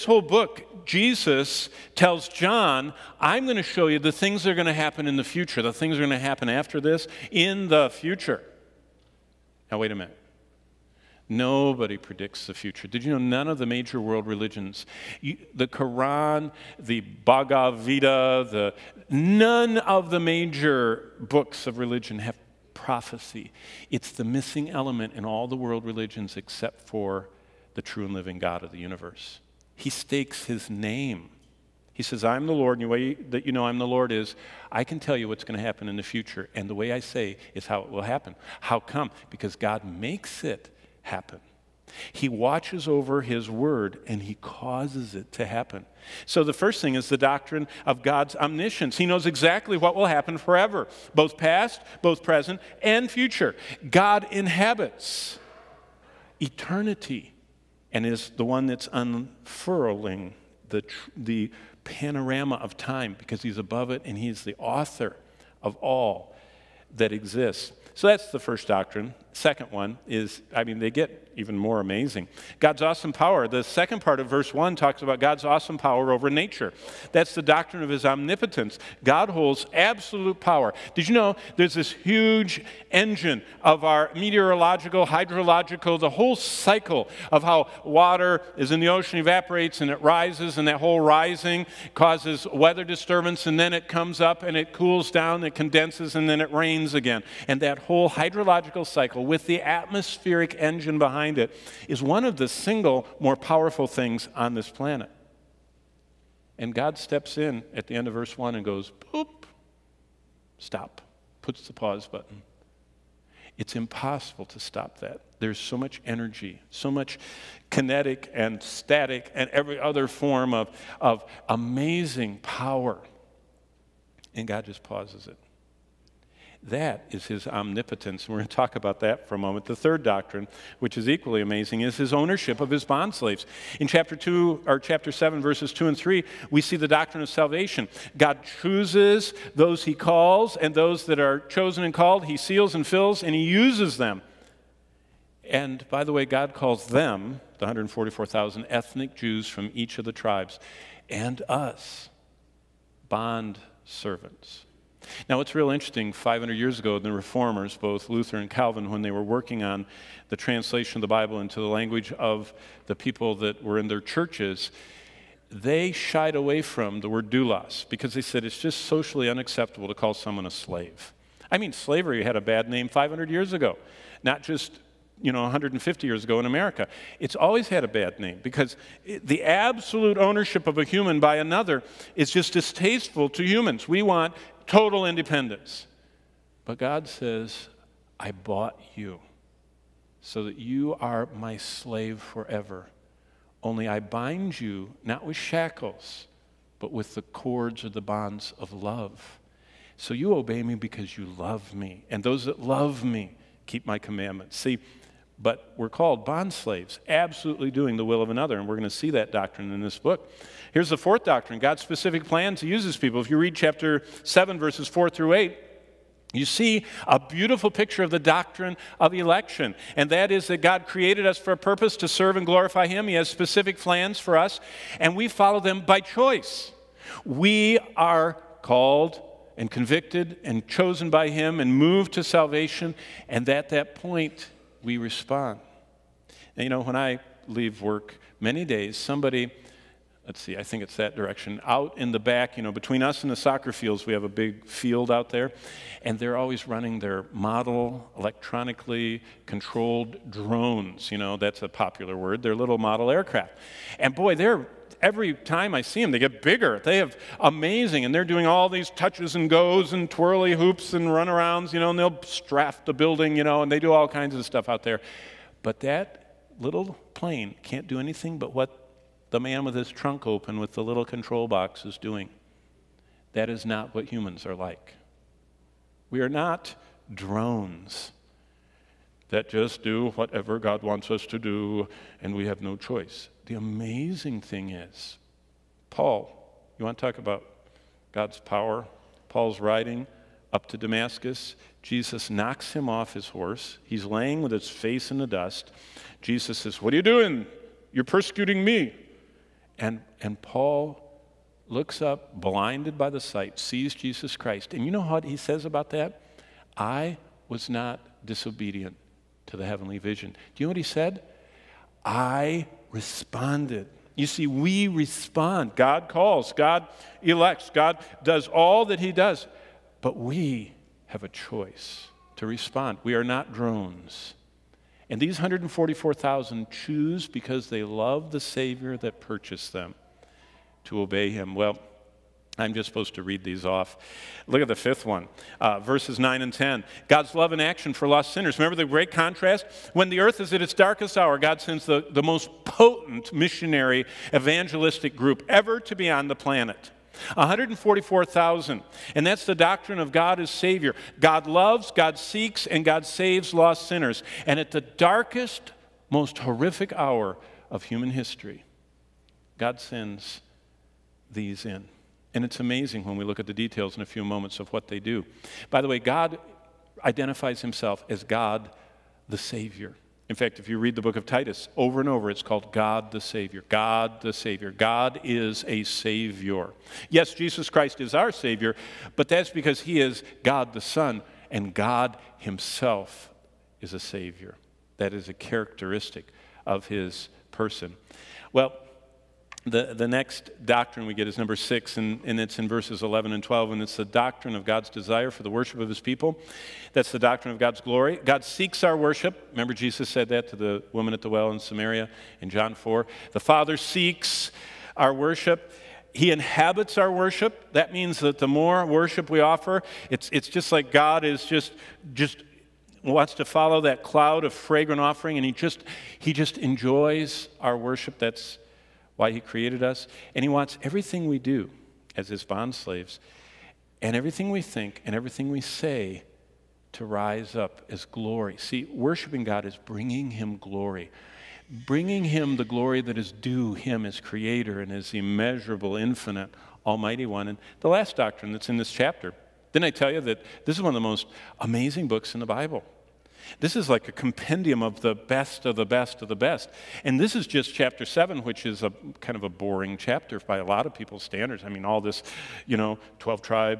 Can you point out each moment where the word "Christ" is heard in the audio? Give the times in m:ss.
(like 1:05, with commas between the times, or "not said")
5:04, 6:17.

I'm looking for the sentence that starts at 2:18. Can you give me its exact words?
God chooses those he calls and those that are chosen and called, he seals and fills and he uses them.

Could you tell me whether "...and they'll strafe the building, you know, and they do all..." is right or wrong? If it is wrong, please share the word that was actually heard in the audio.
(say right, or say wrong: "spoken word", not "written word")
right.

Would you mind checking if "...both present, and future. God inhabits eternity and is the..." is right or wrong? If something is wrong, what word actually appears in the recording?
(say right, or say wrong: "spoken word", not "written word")
right.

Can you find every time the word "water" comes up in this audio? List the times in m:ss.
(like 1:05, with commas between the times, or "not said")
1:27.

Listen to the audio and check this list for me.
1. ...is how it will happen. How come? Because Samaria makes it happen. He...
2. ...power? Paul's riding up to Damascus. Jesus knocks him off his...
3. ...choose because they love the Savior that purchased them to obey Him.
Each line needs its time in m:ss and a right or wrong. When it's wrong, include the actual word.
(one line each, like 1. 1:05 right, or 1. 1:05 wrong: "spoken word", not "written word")
1. 0:37 wrong: "God", not "Samaria"
2. 4:48 right
3. 5:26 right.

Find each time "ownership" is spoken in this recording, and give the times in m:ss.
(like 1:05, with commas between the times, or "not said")
2:12, 3:00.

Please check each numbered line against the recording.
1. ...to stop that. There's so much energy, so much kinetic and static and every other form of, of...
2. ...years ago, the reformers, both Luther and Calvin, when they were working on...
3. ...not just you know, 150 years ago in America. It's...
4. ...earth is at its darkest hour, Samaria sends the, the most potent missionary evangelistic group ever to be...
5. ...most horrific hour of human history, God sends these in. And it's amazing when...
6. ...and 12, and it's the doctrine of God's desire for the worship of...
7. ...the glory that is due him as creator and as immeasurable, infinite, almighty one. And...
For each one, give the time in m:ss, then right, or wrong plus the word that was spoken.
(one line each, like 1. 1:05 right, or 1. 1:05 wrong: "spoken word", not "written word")
1. 1:54 right
2. 2:36 right
3. 2:54 right
4. 5:40 wrong: "God", not "Samaria"
5. 5:56 right
6. 6:33 right
7. 7:12 right.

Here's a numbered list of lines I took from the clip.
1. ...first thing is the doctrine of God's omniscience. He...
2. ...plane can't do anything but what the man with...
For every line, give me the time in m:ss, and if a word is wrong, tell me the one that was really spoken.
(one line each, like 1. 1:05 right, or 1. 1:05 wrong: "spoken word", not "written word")
1. 0:46 right
2. 4:27 right.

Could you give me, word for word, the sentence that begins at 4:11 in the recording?
You know, that's a popular word, they're little model aircraft.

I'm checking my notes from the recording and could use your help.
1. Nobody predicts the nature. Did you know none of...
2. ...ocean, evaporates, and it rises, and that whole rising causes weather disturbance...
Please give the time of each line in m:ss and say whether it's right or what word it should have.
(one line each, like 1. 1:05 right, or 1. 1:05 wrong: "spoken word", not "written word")
1. 0:11 wrong: "future", not "nature"
2. 1:28 right.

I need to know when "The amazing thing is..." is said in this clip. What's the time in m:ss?
4:43.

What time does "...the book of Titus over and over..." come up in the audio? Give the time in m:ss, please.
6:10.